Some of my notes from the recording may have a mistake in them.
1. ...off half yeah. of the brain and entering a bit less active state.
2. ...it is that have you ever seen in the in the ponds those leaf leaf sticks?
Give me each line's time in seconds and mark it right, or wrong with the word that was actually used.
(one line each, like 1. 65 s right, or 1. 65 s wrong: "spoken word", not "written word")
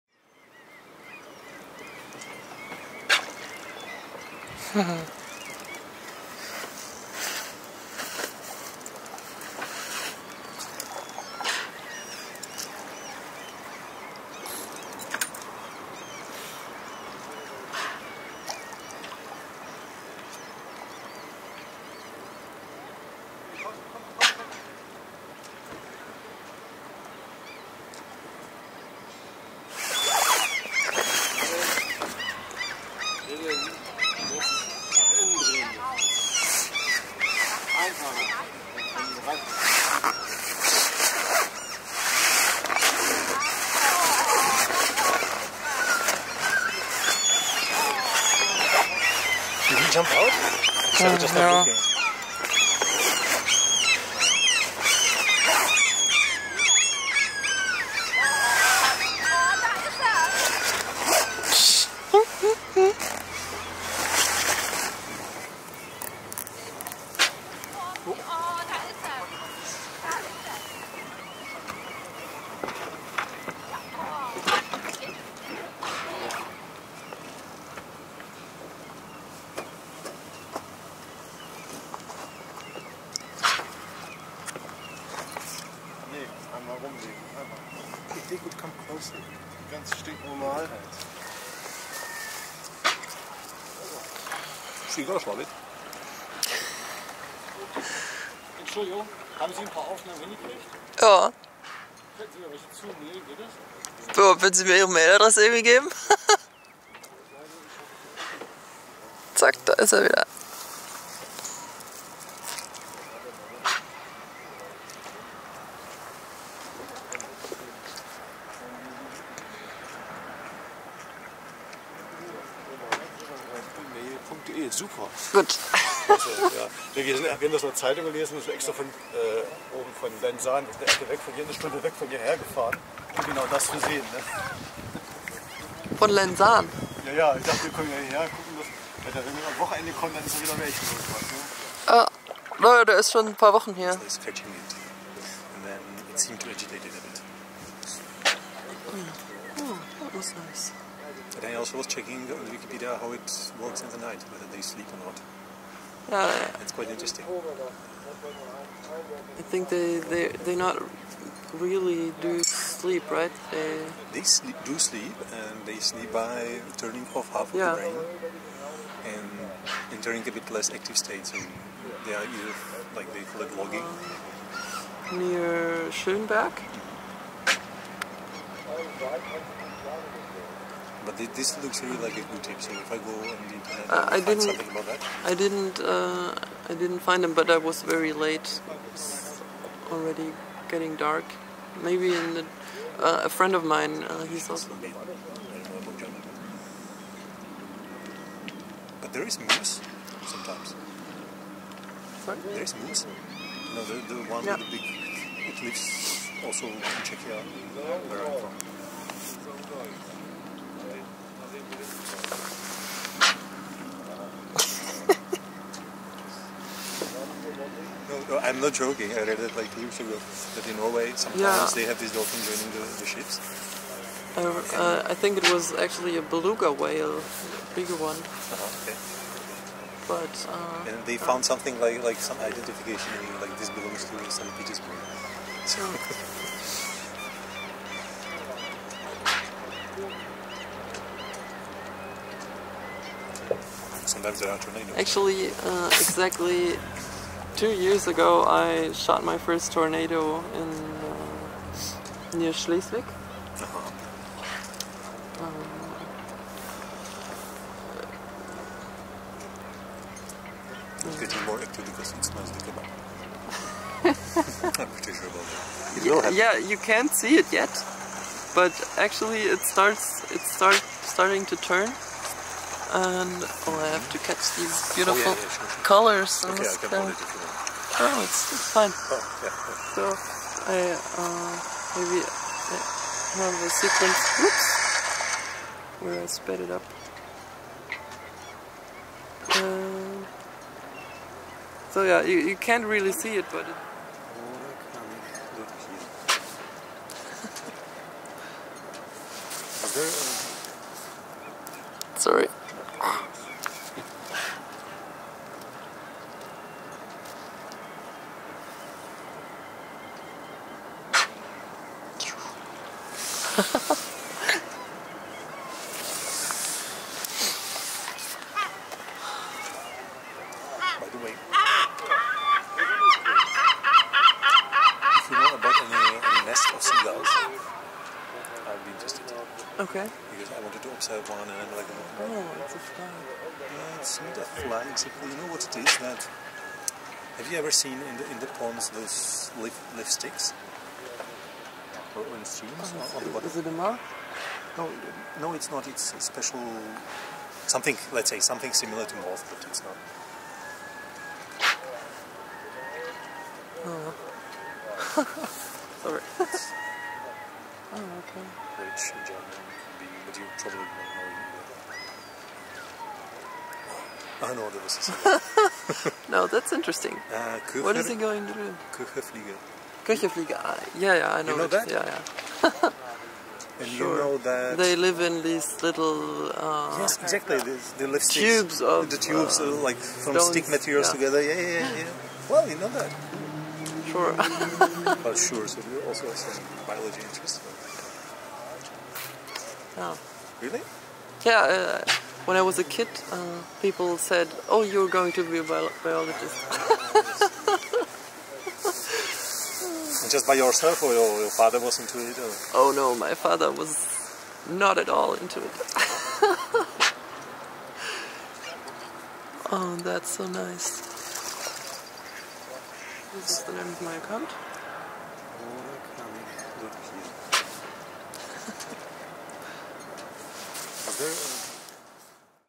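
1. 167 s right
2. 335 s right.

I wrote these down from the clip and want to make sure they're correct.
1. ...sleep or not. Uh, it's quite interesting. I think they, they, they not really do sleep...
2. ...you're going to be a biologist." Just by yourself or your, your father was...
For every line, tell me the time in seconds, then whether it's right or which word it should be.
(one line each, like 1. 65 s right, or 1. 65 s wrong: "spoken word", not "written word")
1. 154 s right
2. 394 s right.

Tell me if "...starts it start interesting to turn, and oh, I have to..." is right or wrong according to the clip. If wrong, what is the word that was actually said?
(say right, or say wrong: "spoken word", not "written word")
wrong: "starting", not "interesting".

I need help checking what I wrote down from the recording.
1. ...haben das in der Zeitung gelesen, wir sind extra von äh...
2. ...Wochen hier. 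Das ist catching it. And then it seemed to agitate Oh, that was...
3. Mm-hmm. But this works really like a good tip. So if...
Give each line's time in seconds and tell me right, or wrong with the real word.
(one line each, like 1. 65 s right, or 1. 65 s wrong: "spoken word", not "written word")
1. 127 s right
2. 143 s right
3. 178 s wrong: "looks", not "works".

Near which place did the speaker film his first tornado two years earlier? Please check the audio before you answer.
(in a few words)
Schleswig.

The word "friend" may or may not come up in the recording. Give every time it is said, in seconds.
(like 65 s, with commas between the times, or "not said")
193 s.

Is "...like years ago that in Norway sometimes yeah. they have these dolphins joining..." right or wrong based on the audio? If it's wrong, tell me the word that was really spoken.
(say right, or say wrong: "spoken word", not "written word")
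right.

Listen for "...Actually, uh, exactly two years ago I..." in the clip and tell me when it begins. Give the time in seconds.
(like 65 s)
244 s.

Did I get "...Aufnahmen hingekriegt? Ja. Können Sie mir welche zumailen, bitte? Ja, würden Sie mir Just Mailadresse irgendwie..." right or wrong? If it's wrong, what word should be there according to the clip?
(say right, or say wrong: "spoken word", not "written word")
wrong: "Ihre", not "Just".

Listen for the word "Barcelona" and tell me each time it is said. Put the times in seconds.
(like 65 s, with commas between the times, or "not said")
not said.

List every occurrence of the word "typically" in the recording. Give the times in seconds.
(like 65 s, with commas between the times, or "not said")
not said.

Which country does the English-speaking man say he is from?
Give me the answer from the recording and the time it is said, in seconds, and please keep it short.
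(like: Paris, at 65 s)
Czechia, at 207 s.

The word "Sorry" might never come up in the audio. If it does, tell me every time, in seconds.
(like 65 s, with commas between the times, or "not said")
202 s, 356 s.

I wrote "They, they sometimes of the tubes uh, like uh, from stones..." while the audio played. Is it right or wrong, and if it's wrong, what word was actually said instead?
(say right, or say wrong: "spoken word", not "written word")
wrong: "tubes", not "sometimes".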